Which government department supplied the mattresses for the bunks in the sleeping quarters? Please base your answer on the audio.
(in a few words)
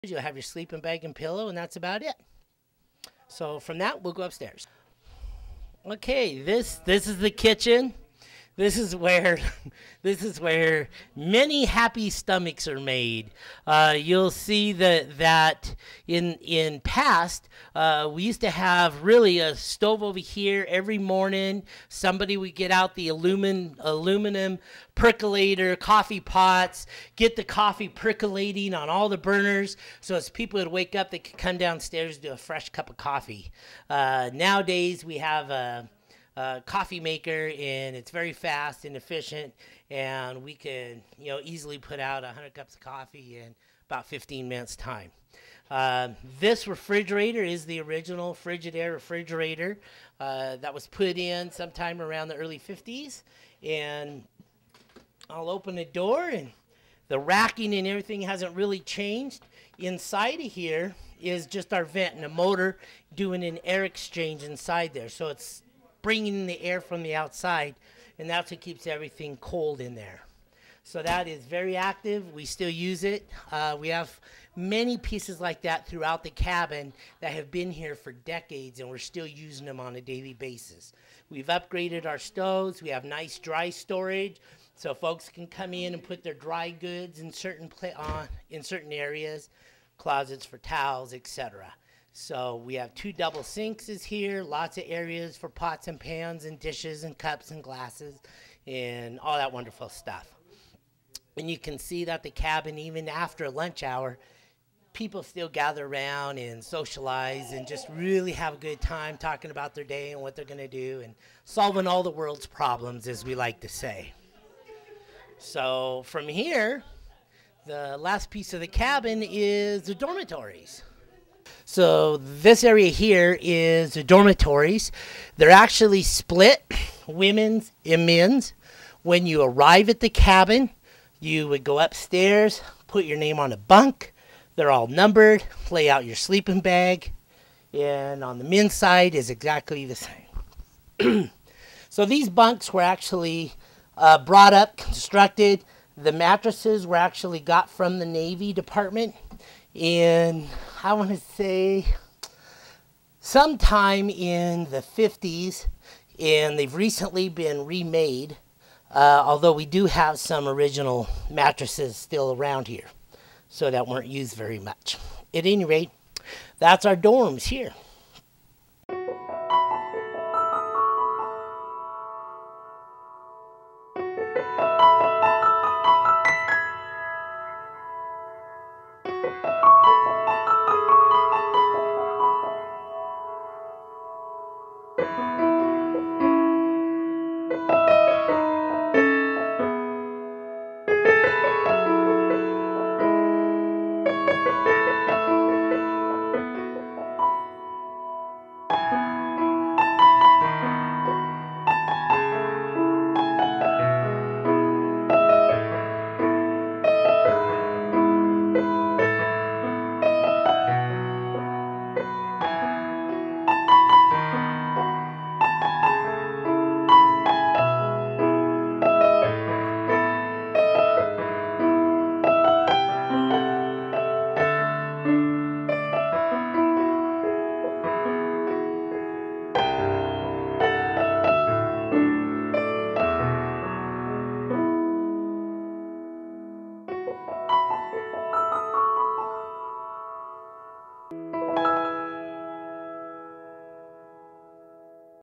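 the Navy Department.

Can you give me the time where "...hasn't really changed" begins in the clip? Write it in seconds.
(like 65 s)
58 s.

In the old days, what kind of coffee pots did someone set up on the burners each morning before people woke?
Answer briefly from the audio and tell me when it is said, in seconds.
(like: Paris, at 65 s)
aluminum percolator, at 23 s.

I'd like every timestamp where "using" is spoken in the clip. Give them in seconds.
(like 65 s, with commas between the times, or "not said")
79 s.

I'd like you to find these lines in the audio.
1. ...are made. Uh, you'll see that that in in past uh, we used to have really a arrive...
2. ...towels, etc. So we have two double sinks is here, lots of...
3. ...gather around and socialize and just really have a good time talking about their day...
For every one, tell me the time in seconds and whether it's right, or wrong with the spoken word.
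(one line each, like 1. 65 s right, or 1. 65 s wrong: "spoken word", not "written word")
1. 12 s wrong: "stove", not "arrive"
2. 90 s right
3. 105 s right.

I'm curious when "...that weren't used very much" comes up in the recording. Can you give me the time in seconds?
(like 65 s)
163 s.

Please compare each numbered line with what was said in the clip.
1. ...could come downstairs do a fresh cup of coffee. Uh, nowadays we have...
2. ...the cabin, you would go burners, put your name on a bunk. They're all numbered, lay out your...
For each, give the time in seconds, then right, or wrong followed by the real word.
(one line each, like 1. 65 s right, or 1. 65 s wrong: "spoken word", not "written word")
1. 31 s right
2. 130 s wrong: "upstairs", not "burners".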